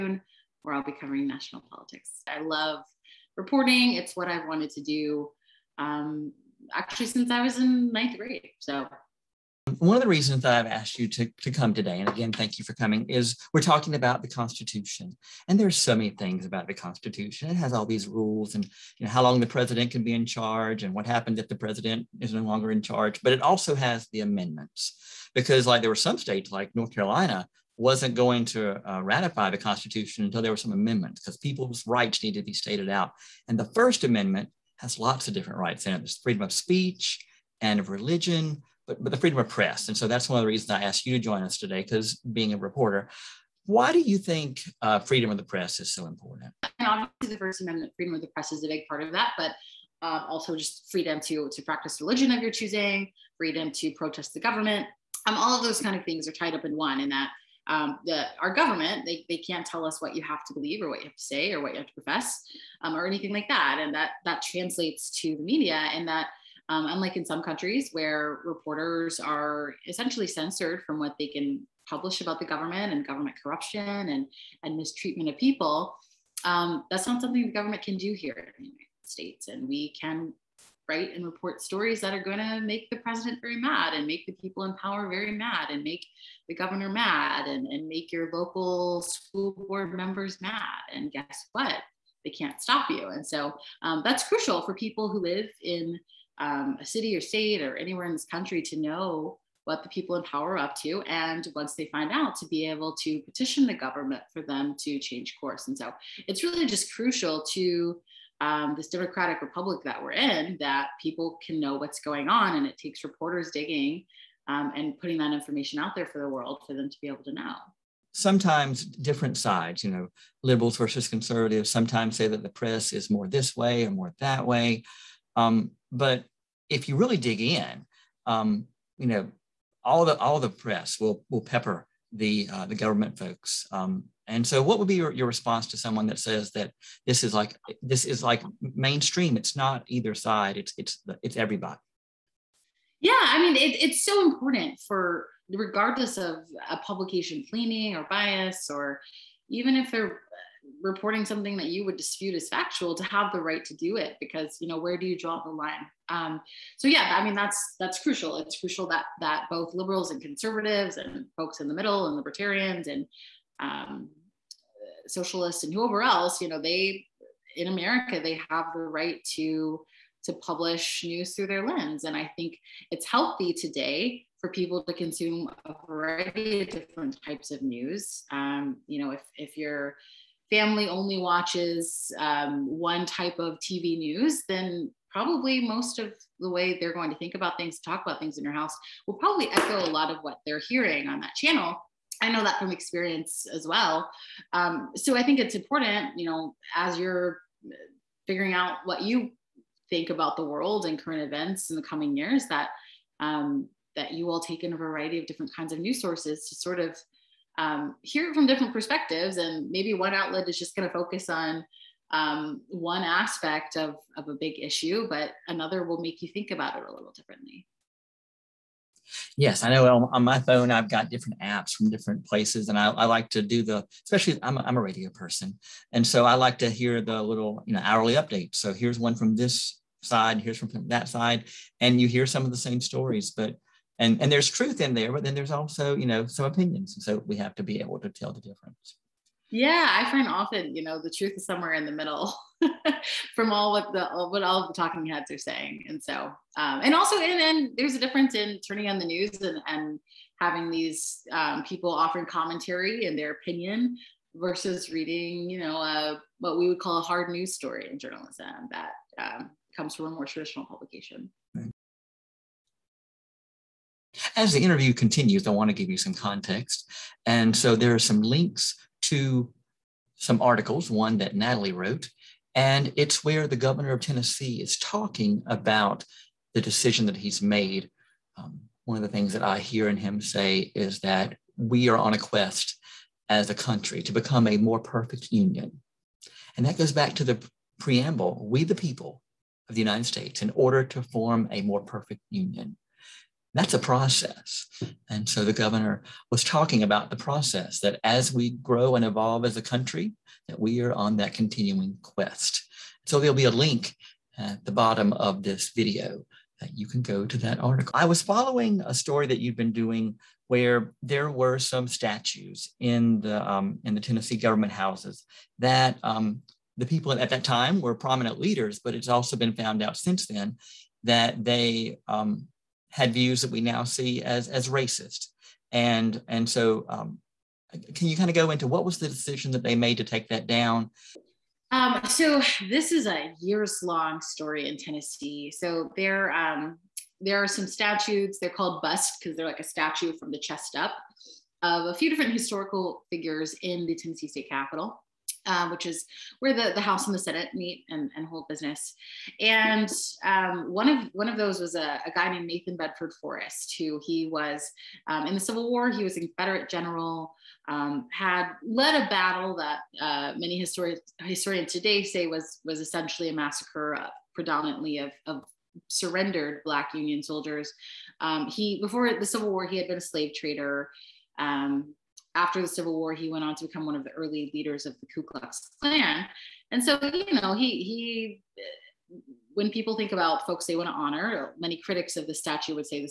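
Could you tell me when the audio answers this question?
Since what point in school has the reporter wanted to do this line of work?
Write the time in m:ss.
0:07.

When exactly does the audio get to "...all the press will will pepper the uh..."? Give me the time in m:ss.
2:10.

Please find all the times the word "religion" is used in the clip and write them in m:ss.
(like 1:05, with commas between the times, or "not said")
0:37, 0:52.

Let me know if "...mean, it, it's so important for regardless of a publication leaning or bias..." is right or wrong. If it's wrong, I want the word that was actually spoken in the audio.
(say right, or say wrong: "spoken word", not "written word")
right.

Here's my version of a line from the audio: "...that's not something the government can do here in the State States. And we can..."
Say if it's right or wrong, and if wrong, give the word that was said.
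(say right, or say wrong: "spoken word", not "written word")
wrong: "United", not "State".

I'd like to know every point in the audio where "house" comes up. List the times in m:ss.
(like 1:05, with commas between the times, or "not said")
3:08, 5:14, 5:46.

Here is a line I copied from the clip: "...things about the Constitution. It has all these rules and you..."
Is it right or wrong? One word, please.
right.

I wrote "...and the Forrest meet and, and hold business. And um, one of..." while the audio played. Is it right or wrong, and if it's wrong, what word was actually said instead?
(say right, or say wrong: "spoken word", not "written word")
wrong: "Senate", not "Forrest".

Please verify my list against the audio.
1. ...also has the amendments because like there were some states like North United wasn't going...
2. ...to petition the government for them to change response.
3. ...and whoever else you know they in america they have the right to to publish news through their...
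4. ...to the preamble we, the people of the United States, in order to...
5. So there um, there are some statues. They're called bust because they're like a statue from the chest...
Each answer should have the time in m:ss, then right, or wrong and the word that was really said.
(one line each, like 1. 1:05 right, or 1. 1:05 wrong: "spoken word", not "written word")
1. 0:23 wrong: "Carolina", not "United"
2. 1:43 wrong: "course", not "response"
3. 2:45 right
4. 4:47 right
5. 5:35 right.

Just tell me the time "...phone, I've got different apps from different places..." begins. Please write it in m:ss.
3:40.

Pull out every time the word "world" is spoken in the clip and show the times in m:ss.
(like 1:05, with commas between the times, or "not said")
1:56, 3:20.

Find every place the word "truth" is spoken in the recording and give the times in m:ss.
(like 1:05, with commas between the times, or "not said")
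3:54, 4:01.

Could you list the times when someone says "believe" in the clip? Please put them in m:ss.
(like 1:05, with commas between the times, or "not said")
1:00.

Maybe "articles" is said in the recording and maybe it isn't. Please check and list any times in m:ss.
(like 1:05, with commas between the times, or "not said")
4:30, 5:07.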